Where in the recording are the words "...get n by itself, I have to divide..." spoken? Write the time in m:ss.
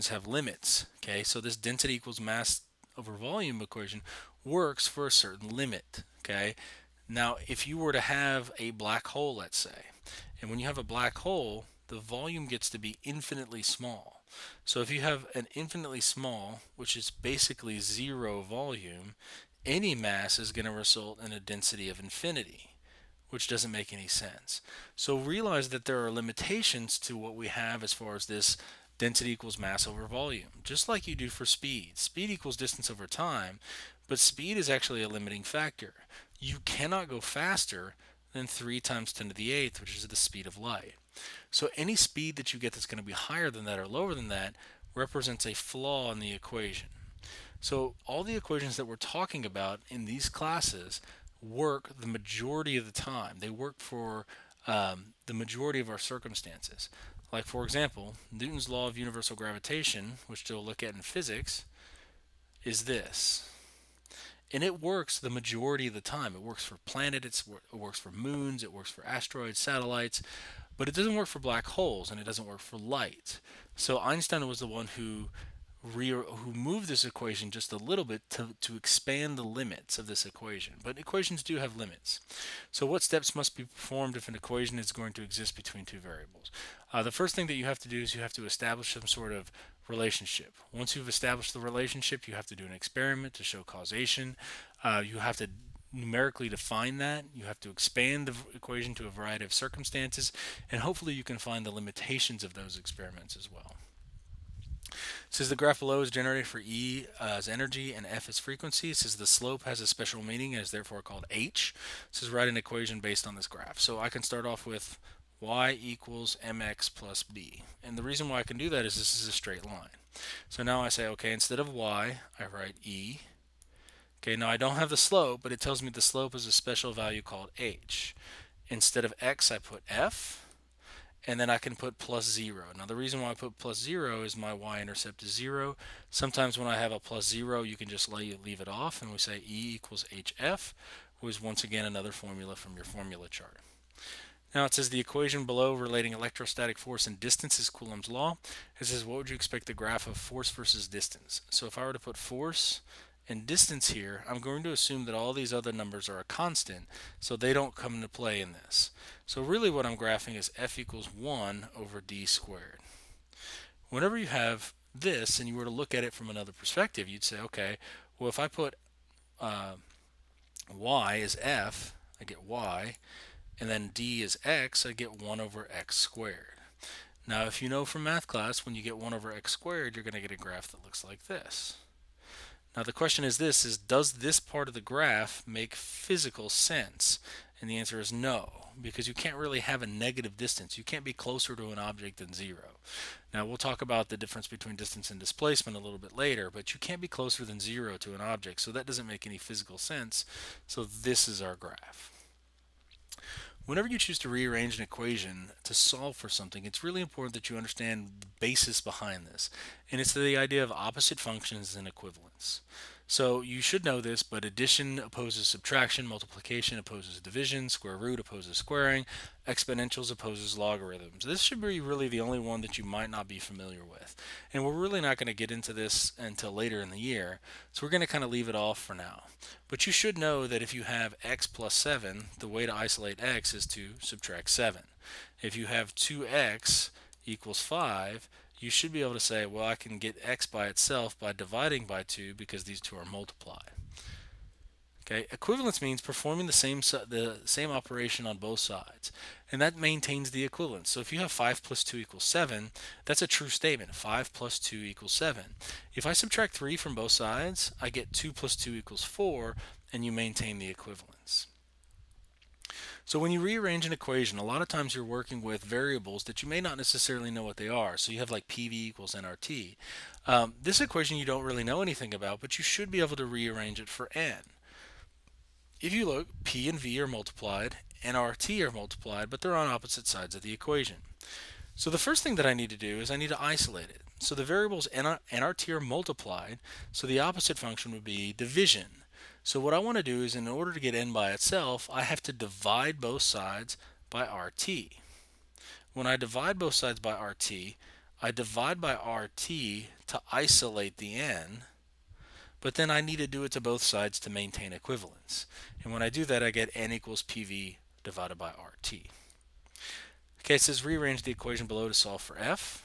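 4:50.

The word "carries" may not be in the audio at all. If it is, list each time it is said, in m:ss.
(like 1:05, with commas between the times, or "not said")
not said.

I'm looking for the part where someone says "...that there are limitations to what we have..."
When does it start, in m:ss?
0:25.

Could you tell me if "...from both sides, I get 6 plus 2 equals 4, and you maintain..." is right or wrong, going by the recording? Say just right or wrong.
wrong.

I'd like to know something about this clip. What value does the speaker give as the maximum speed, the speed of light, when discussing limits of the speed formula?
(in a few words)
3 x 10^8.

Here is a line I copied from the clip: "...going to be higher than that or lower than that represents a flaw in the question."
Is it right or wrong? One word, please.
wrong.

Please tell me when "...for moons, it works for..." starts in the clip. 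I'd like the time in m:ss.
1:07.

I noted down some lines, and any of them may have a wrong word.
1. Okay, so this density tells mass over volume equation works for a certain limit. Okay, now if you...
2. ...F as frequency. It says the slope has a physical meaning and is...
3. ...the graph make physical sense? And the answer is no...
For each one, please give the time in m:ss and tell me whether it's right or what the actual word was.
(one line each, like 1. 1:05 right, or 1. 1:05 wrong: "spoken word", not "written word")
1. 0:01 wrong: "equals", not "tells"
2. 1:48 wrong: "special", not "physical"
3. 3:04 right.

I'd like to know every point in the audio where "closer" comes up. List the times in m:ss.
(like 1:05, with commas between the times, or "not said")
3:11, 3:17.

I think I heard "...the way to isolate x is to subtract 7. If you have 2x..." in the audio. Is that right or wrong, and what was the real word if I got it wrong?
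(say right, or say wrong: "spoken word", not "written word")
right.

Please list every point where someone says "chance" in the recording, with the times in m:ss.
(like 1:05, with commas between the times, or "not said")
not said.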